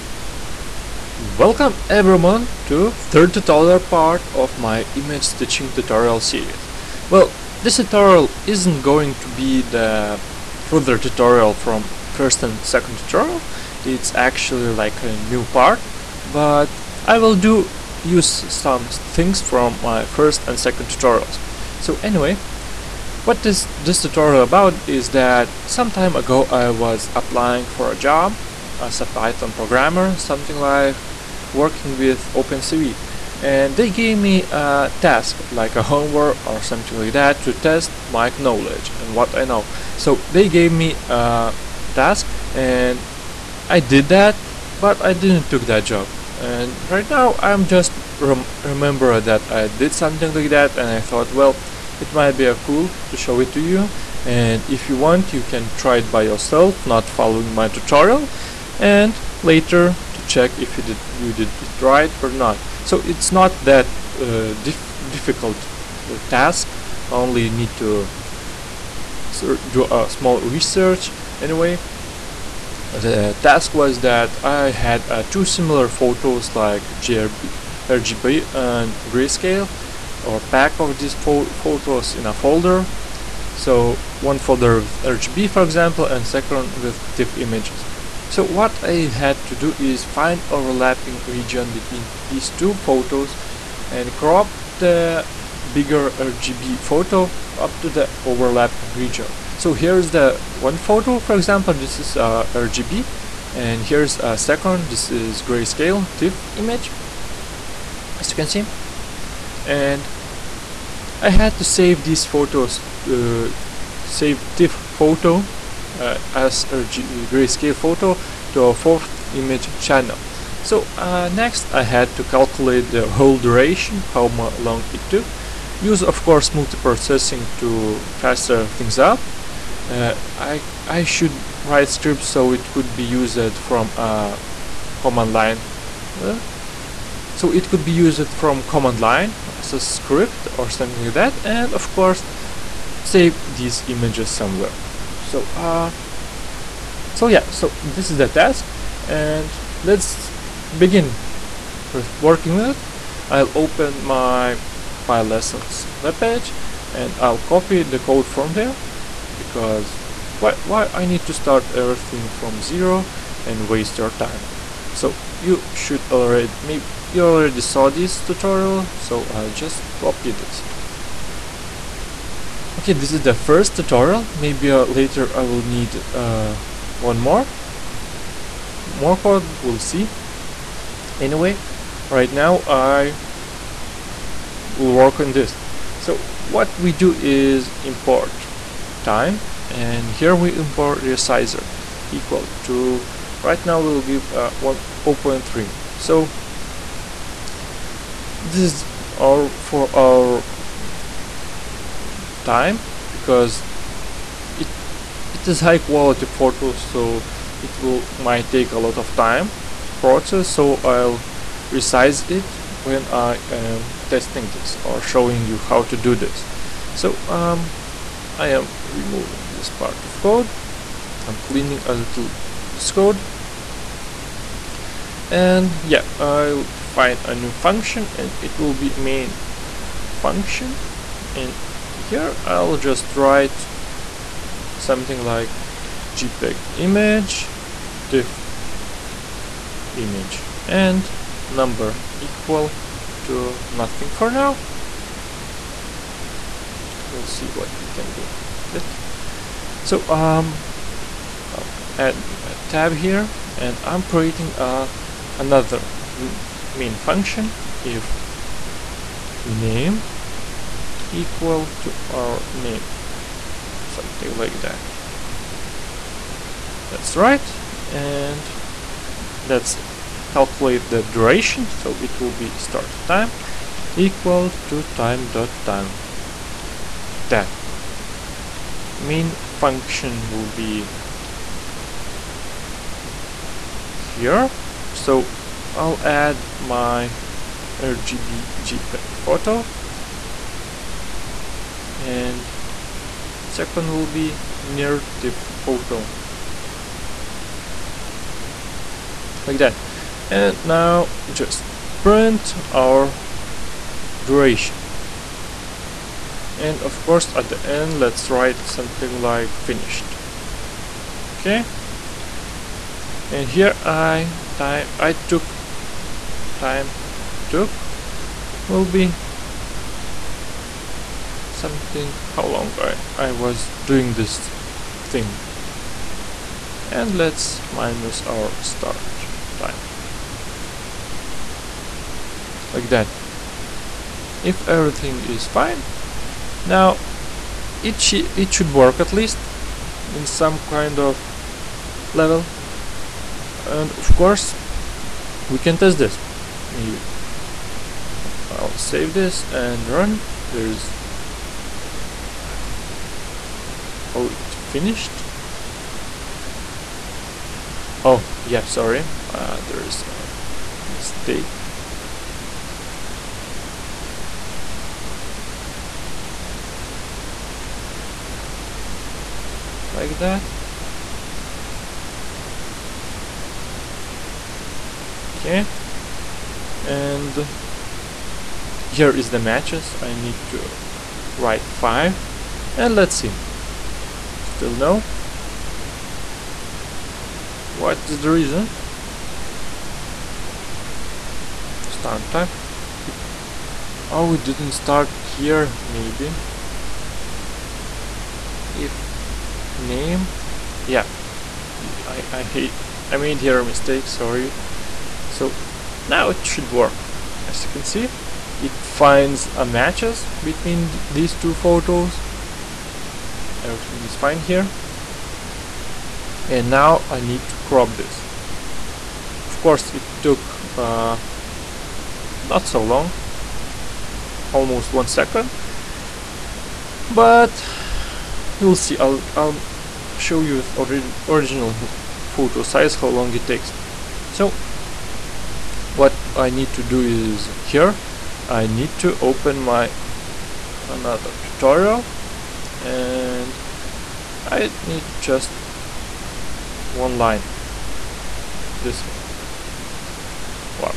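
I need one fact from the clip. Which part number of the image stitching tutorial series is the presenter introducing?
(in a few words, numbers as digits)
third.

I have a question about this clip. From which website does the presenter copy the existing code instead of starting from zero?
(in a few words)
PyLessons.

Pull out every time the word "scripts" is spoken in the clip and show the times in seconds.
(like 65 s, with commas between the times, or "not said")
131 s, 139 s.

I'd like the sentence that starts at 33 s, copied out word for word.
And they gave me a task, like a homework or something like that, to test my knowledge and what I know.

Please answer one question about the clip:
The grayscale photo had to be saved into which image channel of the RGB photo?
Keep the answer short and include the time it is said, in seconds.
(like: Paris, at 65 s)
fourth, at 118 s.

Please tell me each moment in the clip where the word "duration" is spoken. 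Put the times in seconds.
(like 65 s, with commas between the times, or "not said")
123 s, 271 s, 304 s.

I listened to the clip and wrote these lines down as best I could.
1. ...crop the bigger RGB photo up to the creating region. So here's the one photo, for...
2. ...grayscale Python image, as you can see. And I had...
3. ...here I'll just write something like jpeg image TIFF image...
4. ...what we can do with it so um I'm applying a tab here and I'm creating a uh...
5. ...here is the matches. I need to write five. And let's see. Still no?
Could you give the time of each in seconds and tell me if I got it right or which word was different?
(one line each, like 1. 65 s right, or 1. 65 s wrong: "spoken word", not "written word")
1. 94 s wrong: "overlapping", not "creating"
2. 105 s wrong: "TIFF", not "Python"
3. 232 s right
4. 247 s wrong: "adding", not "applying"
5. 378 s right.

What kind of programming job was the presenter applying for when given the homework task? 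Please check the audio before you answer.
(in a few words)
Python programmer.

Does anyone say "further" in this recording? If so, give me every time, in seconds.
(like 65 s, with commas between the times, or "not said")
10 s.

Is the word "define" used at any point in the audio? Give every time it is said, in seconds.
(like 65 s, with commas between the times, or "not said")
226 s.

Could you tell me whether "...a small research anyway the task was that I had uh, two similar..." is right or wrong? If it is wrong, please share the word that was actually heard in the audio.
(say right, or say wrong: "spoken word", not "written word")
right.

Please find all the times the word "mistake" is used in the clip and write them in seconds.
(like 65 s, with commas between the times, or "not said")
360 s, 403 s.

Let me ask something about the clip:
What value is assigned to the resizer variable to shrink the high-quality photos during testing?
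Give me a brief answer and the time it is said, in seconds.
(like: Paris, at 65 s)
0.3, at 194 s.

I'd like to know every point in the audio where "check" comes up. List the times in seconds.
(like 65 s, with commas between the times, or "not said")
60 s.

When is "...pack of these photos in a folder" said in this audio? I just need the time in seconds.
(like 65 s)
80 s.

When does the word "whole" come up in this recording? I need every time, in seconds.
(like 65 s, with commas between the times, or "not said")
123 s.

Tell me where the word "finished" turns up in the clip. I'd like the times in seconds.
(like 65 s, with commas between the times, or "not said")
309 s, 354 s.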